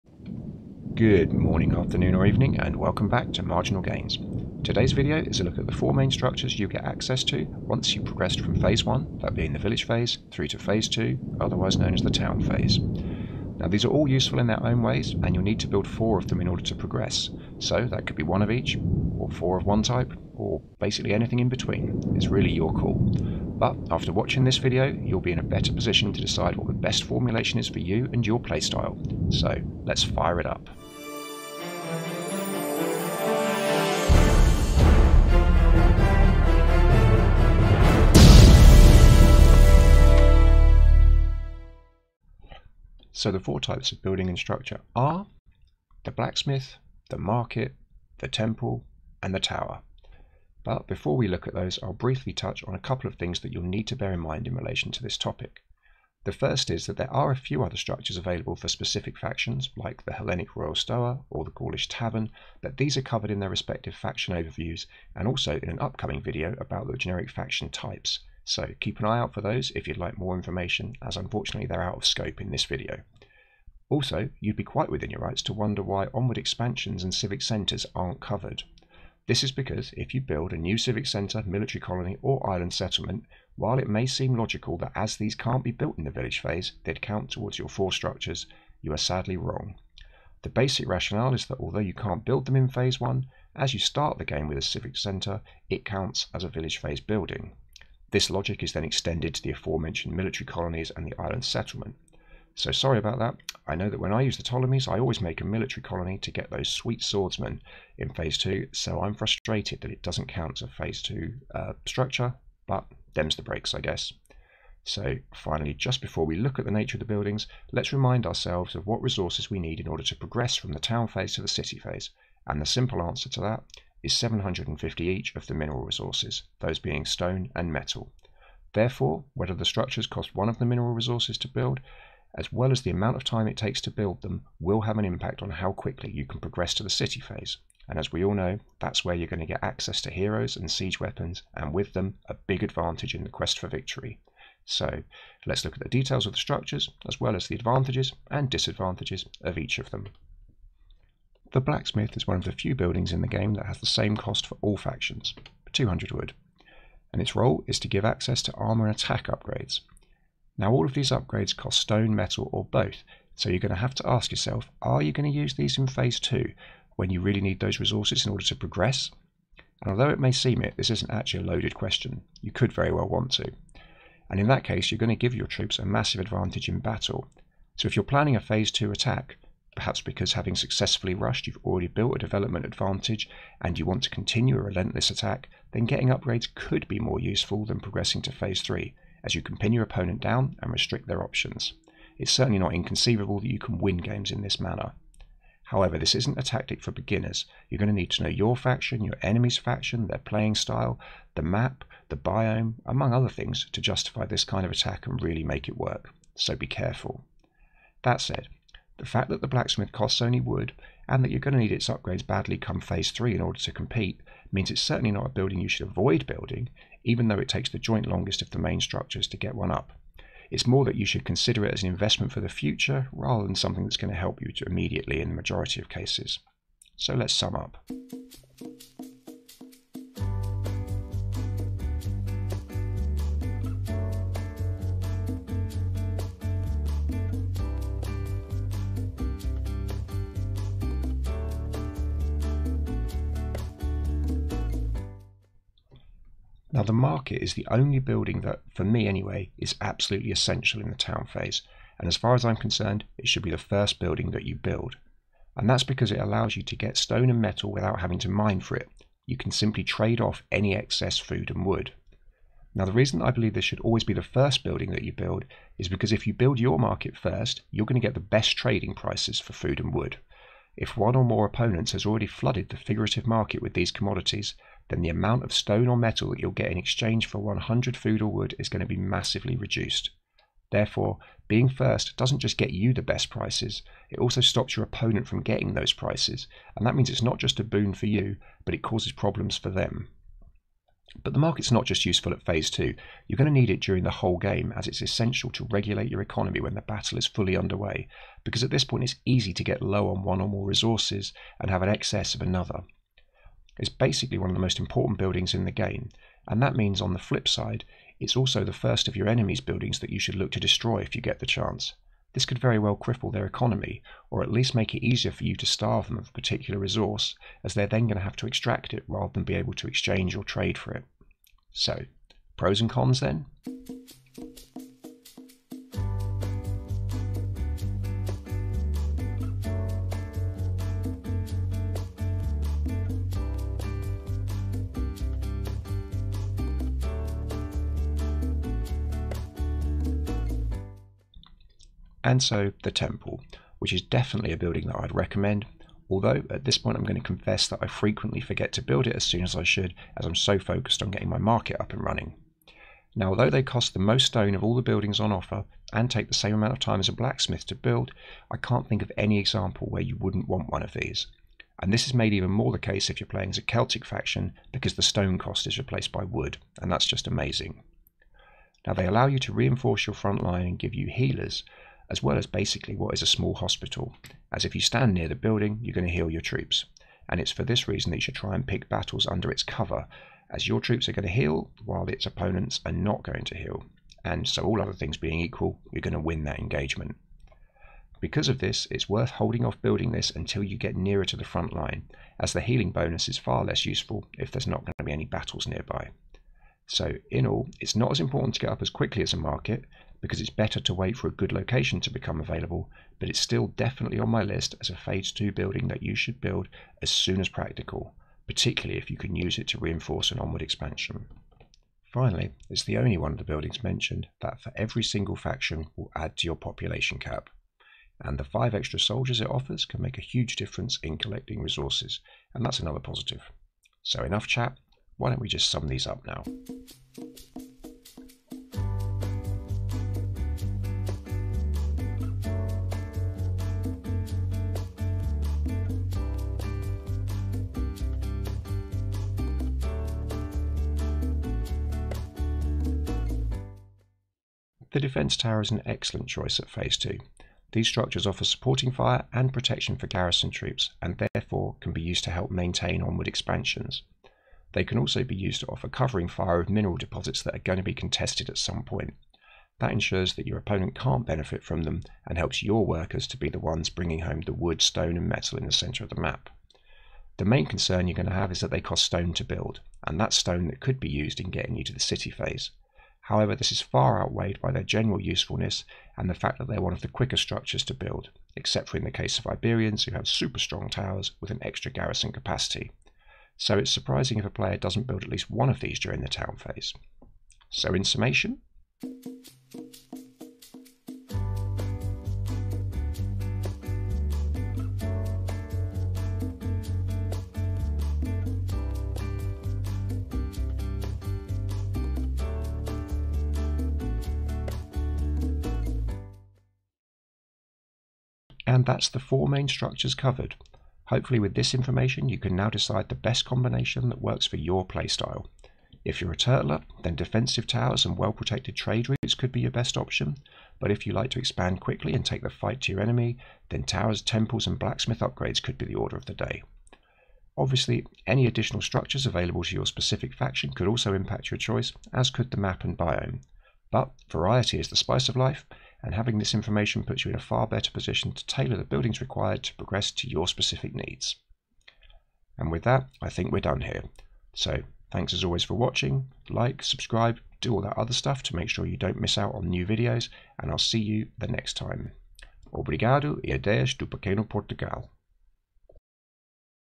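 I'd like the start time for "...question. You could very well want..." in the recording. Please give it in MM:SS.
02:51.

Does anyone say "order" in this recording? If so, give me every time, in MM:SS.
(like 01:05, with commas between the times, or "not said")
00:16, 01:59, 02:48, 03:33, 08:45.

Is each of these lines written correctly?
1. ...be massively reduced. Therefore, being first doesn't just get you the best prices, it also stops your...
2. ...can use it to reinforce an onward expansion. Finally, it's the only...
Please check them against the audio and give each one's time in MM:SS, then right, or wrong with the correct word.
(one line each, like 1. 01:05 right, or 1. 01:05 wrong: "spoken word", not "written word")
1. 04:38 right
2. 06:49 right.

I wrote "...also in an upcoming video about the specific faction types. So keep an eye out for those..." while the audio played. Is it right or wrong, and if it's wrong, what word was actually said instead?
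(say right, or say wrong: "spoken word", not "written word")
wrong: "generic", not "specific".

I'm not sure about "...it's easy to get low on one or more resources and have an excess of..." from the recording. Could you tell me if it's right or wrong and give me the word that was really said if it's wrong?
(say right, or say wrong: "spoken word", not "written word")
right.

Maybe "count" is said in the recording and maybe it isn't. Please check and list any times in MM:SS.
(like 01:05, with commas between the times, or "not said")
01:27, 01:35, 01:50.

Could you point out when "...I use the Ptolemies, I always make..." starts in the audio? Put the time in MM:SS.
01:44.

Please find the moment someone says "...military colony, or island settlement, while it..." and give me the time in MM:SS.
01:21.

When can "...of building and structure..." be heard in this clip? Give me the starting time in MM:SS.
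00:43.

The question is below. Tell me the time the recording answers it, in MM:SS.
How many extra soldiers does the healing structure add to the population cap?
06:58.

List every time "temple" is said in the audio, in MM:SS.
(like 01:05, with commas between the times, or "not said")
00:48, 05:42, 08:44.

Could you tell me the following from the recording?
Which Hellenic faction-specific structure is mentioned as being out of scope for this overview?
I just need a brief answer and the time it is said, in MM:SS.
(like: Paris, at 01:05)
Royal Stoa, at 01:00.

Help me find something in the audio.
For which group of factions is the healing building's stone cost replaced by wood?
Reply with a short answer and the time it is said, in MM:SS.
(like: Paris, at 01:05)
Celtic, at 06:03.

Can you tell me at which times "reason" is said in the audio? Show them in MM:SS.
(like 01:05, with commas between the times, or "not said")
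04:22, 06:17.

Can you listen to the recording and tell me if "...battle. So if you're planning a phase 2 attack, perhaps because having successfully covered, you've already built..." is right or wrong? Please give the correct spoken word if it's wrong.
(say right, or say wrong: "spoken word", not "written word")
wrong: "rushed", not "covered".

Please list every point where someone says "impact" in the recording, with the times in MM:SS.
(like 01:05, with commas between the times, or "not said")
02:15, 08:51.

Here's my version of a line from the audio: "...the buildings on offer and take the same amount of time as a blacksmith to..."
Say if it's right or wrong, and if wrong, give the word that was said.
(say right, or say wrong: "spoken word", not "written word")
right.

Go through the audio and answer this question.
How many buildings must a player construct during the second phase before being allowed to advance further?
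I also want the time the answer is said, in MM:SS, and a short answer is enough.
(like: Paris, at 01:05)
4, at 00:15.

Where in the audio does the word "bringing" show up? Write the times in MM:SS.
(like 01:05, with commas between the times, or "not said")
07:43.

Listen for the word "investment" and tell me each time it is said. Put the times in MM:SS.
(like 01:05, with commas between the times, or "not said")
03:41.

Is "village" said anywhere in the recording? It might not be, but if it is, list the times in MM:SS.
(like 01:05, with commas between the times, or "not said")
00:09, 01:26, 01:36.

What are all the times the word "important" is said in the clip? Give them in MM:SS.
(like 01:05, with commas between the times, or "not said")
05:04, 06:38.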